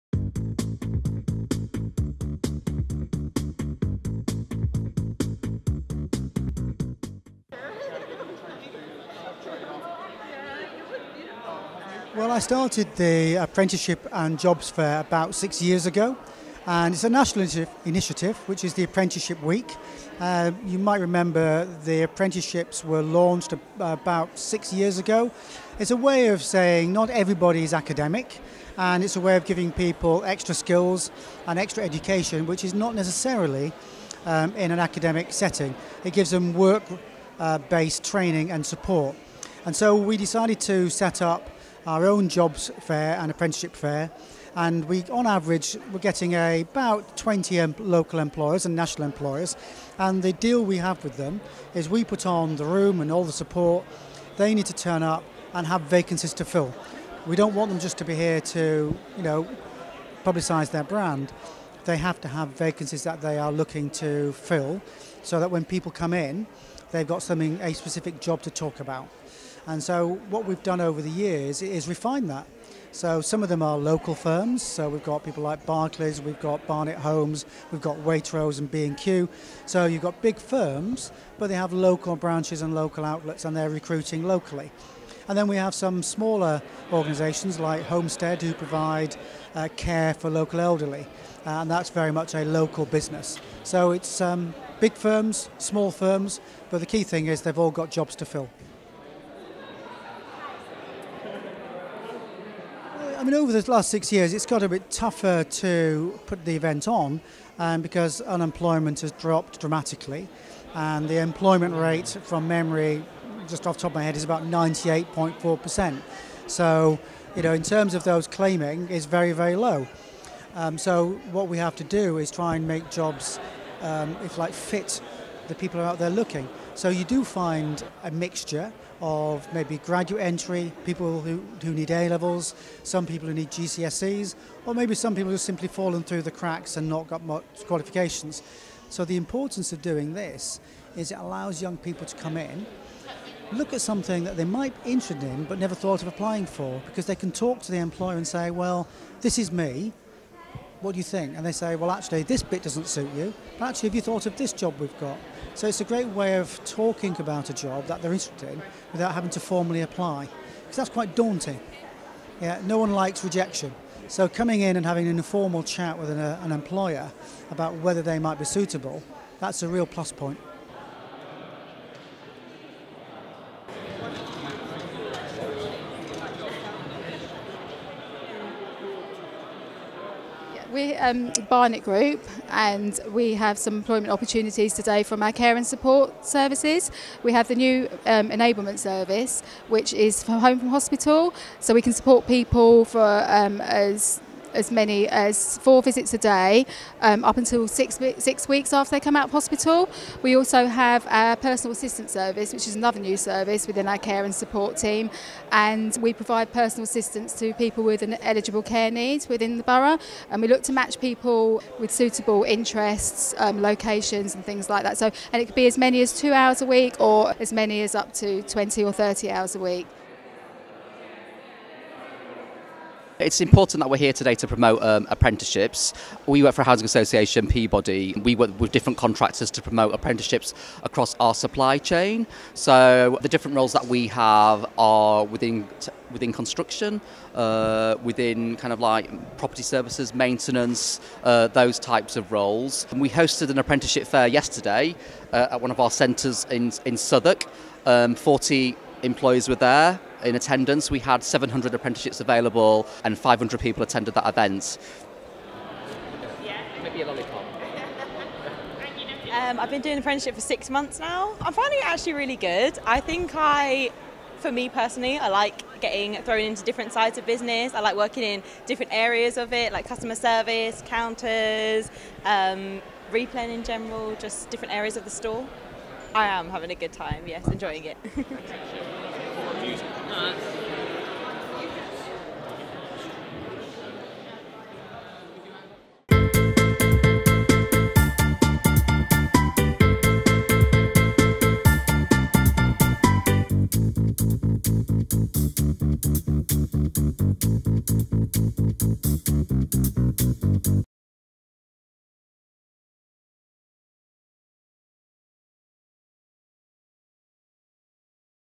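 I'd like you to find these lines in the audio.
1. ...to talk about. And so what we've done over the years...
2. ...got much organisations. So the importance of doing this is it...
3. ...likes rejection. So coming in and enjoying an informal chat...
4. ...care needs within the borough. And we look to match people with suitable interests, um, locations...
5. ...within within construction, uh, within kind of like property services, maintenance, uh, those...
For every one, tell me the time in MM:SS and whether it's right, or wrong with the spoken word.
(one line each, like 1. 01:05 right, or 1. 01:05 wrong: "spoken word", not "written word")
1. 01:08 right
2. 02:17 wrong: "qualifications", not "organisations"
3. 02:42 wrong: "having", not "enjoying"
4. 03:28 right
5. 03:55 right.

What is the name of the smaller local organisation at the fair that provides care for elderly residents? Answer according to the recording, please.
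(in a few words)
Homestead.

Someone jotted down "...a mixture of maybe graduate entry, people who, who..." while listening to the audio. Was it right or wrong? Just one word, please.
right.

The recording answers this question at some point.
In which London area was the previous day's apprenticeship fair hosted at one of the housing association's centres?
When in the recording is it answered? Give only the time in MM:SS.
04:06.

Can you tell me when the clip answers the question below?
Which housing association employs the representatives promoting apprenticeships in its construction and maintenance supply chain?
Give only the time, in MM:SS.
03:47.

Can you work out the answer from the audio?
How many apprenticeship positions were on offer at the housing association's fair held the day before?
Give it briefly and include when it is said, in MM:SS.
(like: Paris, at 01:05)
700, at 04:11.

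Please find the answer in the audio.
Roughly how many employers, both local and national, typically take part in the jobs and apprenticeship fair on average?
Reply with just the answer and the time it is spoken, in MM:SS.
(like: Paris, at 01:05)
20, at 00:46.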